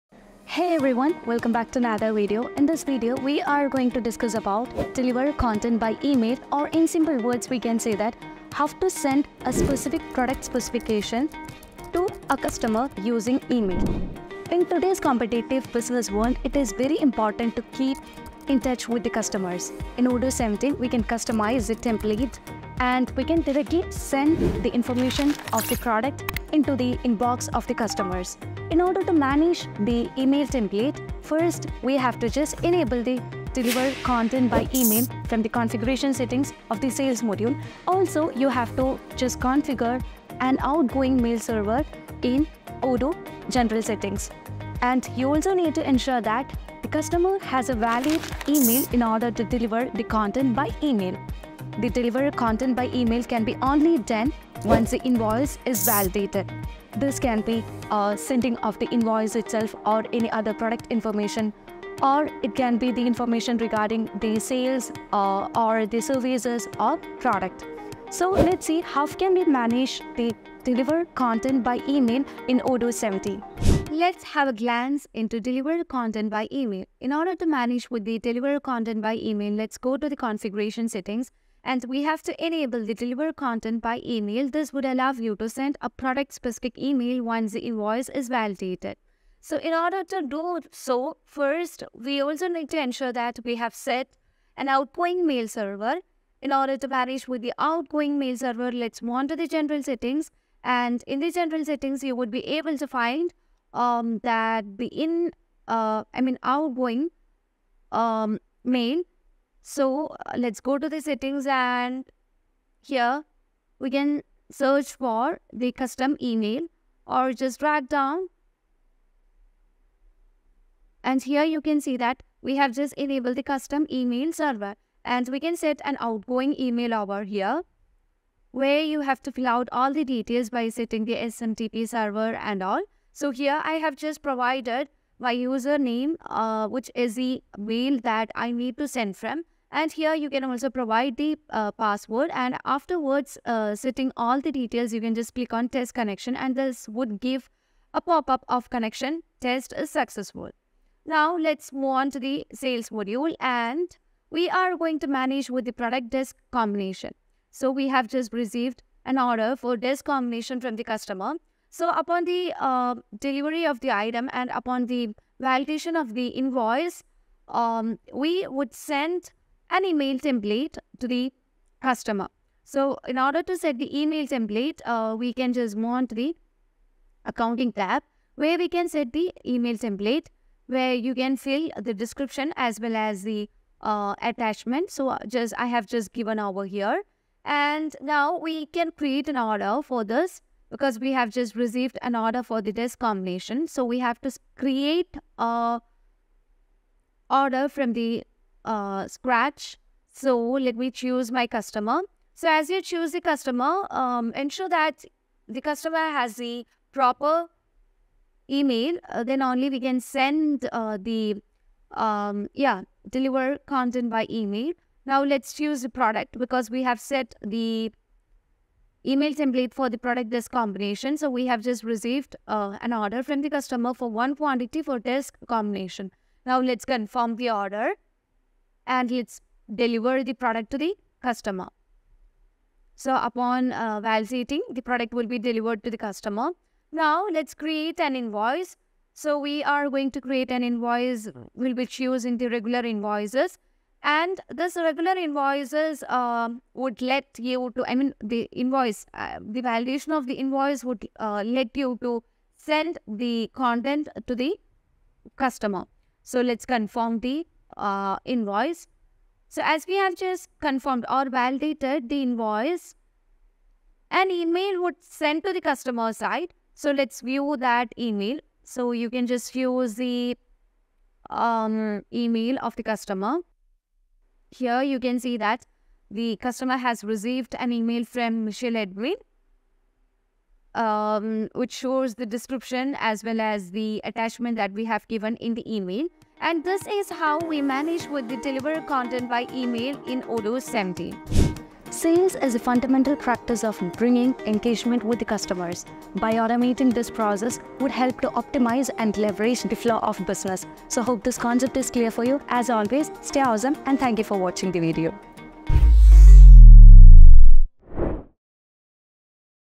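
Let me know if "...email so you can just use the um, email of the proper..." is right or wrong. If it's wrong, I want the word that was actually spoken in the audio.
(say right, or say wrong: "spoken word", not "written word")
wrong: "customer", not "proper".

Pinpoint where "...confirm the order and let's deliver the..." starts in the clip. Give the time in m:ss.
3:46.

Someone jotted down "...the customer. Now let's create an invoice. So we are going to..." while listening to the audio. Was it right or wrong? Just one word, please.
right.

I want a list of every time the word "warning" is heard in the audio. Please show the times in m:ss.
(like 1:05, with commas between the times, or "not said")
not said.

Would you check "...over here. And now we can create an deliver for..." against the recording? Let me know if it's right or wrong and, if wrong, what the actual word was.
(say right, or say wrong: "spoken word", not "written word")
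wrong: "order", not "deliver".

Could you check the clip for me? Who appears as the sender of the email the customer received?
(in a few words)
Michelle Edwin.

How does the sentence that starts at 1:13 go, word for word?
Let's have a glance into deliver content by email.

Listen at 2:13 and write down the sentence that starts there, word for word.
So here I have just provided my username, uh, which is the mail that I need to send from.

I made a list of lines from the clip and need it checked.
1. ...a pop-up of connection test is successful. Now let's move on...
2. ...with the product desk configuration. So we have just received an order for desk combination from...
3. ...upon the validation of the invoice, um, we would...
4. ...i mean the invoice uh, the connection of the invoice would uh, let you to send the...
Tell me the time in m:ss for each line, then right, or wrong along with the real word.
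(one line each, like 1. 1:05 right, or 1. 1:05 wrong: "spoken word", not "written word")
1. 2:27 right
2. 2:35 wrong: "combination", not "configuration"
3. 2:44 right
4. 4:07 wrong: "validation", not "connection".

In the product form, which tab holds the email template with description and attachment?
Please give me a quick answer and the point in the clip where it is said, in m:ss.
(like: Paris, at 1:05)
Accounting tab, at 2:57.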